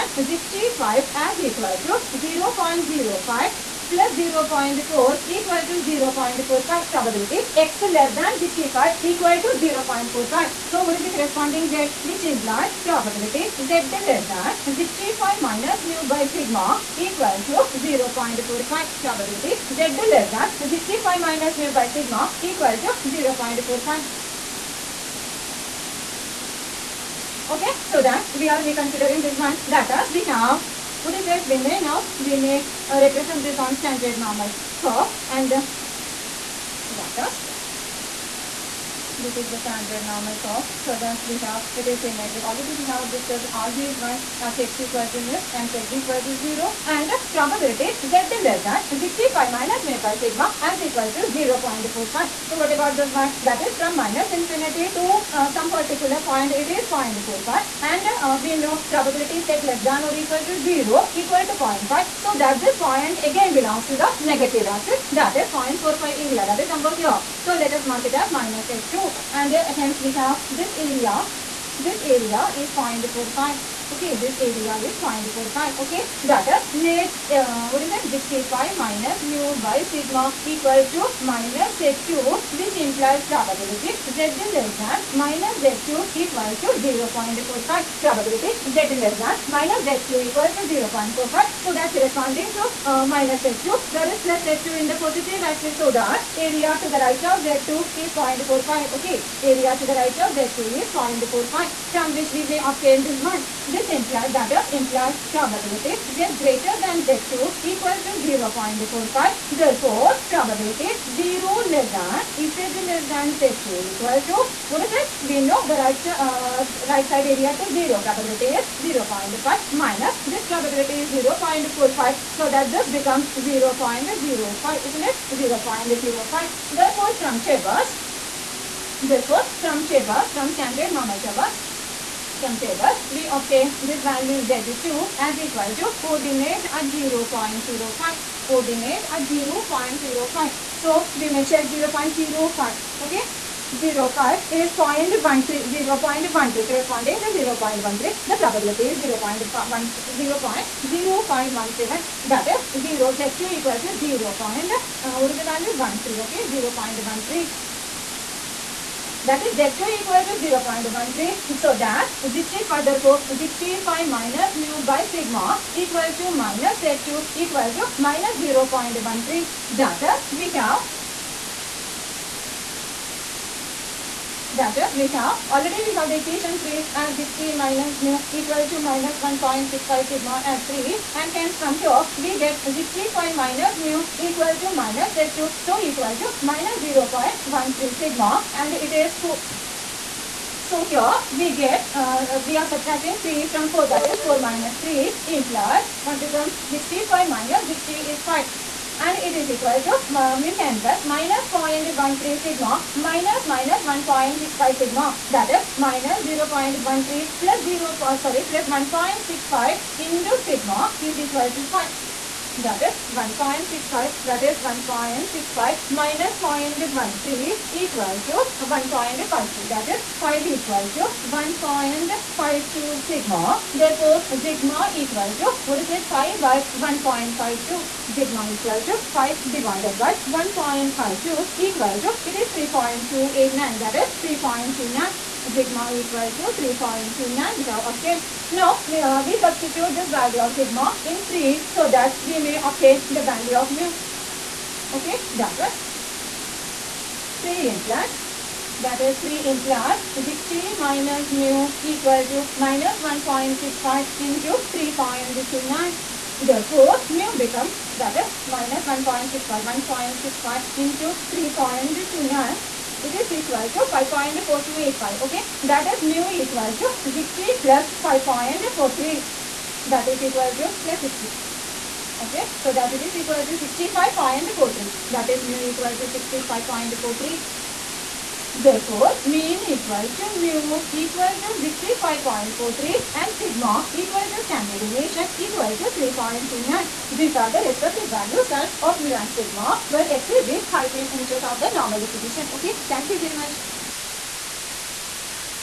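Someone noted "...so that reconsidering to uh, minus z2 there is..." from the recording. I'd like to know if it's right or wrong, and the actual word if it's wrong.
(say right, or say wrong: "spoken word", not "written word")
wrong: "corresponding", not "reconsidering".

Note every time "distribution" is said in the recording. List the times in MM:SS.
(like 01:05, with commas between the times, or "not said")
04:51.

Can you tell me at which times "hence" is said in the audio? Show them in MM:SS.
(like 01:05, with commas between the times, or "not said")
01:09, 03:01.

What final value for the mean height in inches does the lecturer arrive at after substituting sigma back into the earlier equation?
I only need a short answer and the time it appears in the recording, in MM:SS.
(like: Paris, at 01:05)
65.43, at 04:41.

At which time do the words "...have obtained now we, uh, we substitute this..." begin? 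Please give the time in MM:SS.
03:57.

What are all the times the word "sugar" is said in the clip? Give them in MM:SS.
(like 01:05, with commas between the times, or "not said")
not said.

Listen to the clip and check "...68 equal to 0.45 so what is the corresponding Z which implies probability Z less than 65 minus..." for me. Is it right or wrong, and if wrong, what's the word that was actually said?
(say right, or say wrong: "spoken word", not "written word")
wrong: "65", not "68".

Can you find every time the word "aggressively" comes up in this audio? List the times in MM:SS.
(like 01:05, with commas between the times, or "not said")
not said.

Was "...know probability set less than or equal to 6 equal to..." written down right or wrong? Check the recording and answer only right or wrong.
wrong.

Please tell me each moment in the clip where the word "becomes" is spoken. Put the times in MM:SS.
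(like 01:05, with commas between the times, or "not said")
02:02, 03:16, 04:17.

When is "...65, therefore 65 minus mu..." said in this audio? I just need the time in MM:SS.
02:42.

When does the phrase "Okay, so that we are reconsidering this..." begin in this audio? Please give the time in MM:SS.
00:27.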